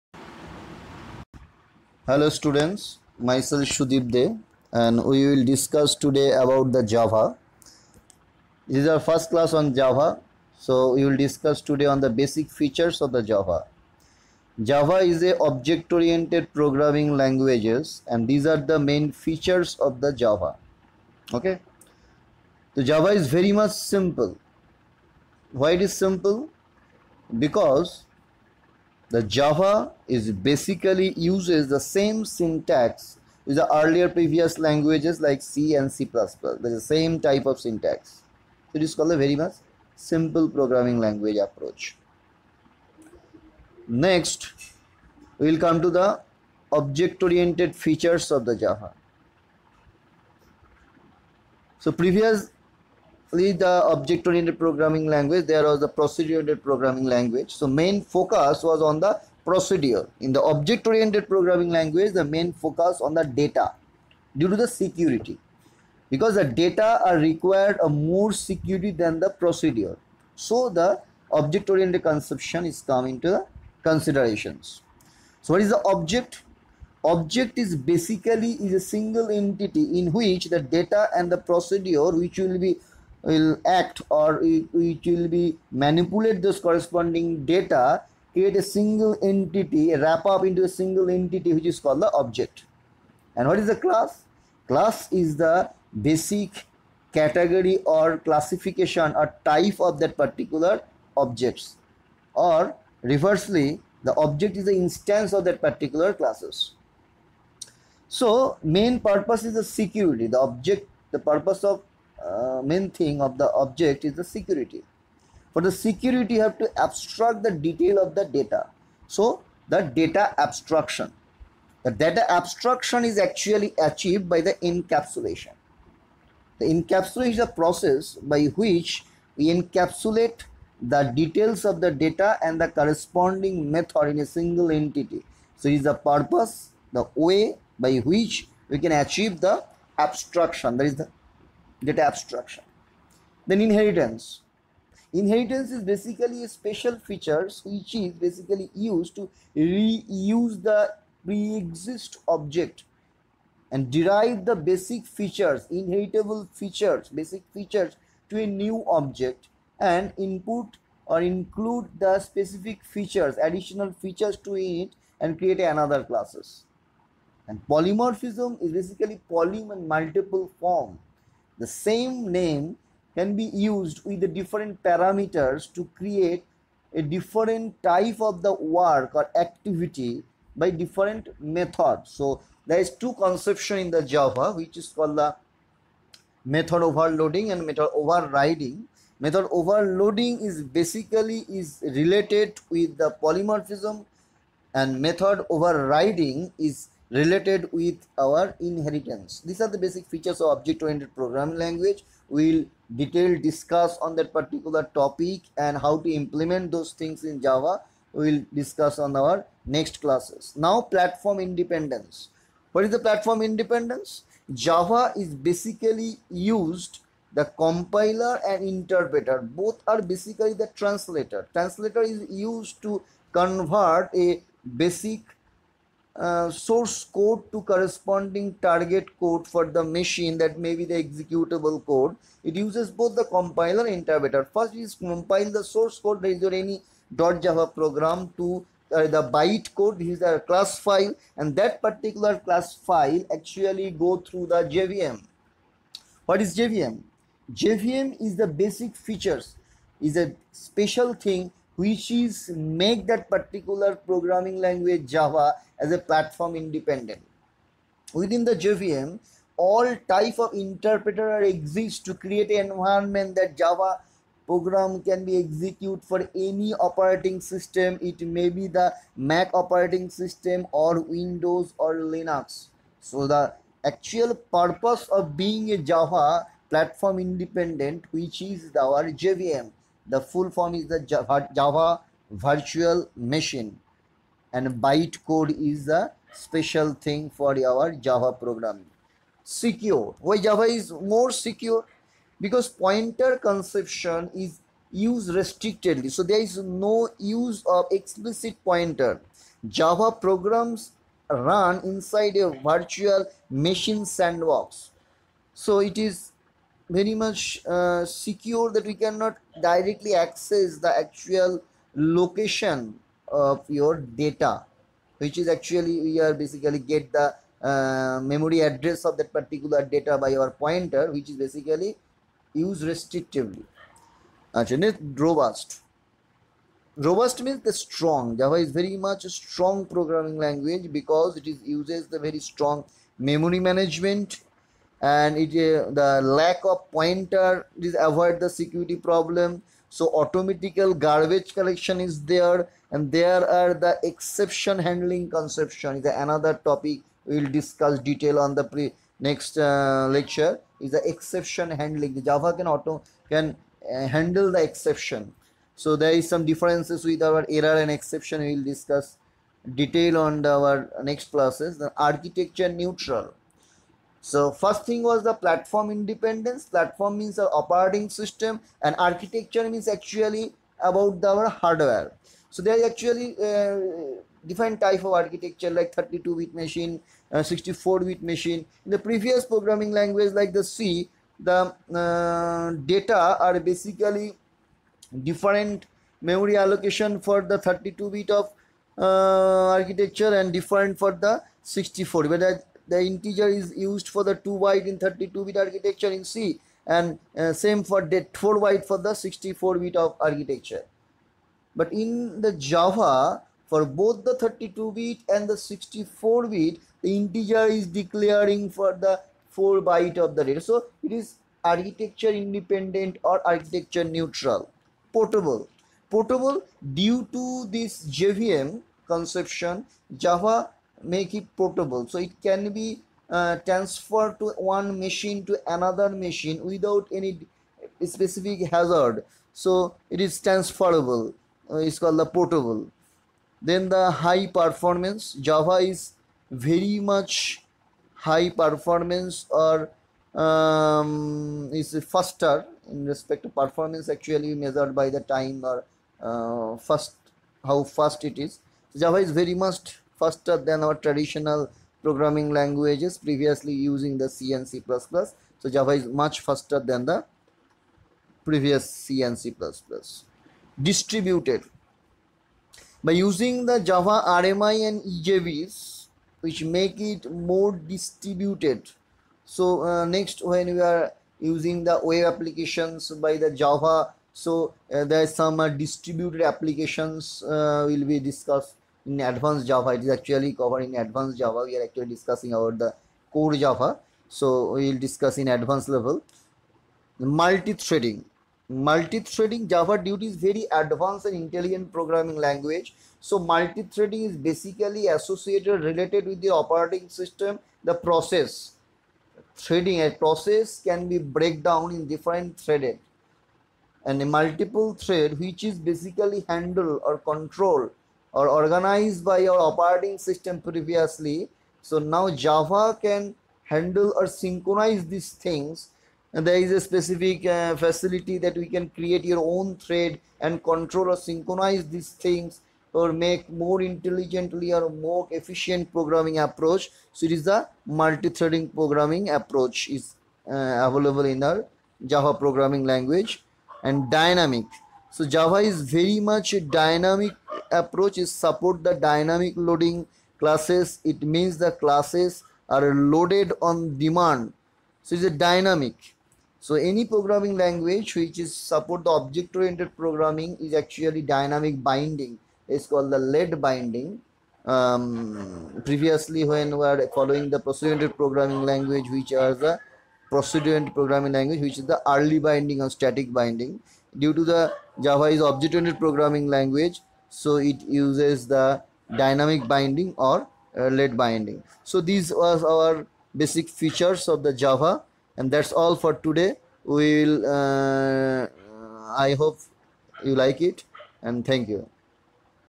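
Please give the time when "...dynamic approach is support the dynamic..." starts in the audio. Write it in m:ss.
8:56.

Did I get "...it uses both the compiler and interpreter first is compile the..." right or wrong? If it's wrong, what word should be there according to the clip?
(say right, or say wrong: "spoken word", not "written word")
right.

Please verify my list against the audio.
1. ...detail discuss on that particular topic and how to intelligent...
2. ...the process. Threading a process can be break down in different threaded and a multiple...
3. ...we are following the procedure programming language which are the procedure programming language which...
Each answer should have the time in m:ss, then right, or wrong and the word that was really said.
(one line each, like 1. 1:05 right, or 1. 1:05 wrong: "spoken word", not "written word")
1. 3:22 wrong: "implement", not "intelligent"
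2. 8:17 right
3. 9:16 right.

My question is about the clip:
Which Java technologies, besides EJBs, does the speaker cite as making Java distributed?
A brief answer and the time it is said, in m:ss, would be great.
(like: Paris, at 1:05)
Java RMI, at 7:43.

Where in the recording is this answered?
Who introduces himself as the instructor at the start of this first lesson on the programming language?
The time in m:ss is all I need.
0:03.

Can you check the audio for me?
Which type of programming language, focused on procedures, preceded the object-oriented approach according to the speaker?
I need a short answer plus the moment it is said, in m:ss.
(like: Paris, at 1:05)
procedure oriented programming language, at 0:55.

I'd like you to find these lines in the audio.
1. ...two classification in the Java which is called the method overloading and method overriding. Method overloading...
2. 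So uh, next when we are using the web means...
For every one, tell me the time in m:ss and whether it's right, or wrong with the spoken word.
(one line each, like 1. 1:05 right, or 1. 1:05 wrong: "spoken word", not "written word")
1. 3:02 wrong: "conception", not "classification"
2. 7:49 wrong: "applications", not "means".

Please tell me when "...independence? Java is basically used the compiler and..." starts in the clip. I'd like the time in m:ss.
3:33.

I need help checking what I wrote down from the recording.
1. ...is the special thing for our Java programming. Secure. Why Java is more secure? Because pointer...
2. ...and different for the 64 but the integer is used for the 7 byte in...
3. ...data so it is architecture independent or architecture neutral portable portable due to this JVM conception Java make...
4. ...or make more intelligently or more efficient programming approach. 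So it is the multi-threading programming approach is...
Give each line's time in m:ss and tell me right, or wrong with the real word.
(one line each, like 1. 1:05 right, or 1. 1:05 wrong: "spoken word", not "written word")
1. 4:45 right
2. 6:30 wrong: "2", not "7"
3. 6:50 right
4. 8:42 right.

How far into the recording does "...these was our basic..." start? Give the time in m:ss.
9:32.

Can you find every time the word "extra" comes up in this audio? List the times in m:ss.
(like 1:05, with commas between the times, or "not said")
not said.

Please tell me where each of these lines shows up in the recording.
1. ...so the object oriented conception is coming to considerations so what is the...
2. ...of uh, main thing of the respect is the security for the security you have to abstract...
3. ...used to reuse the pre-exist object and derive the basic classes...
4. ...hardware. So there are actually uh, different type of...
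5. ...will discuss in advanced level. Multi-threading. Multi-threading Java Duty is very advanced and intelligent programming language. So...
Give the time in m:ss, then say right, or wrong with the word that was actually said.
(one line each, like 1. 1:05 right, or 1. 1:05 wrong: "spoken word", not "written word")
1. 1:10 right
2. 1:51 wrong: "object", not "respect"
3. 2:28 wrong: "features", not "classes"
4. 6:11 right
5. 8:04 right.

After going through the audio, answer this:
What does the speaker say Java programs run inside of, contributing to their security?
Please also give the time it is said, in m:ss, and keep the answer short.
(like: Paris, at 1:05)
virtual machine sandbox, at 5:02.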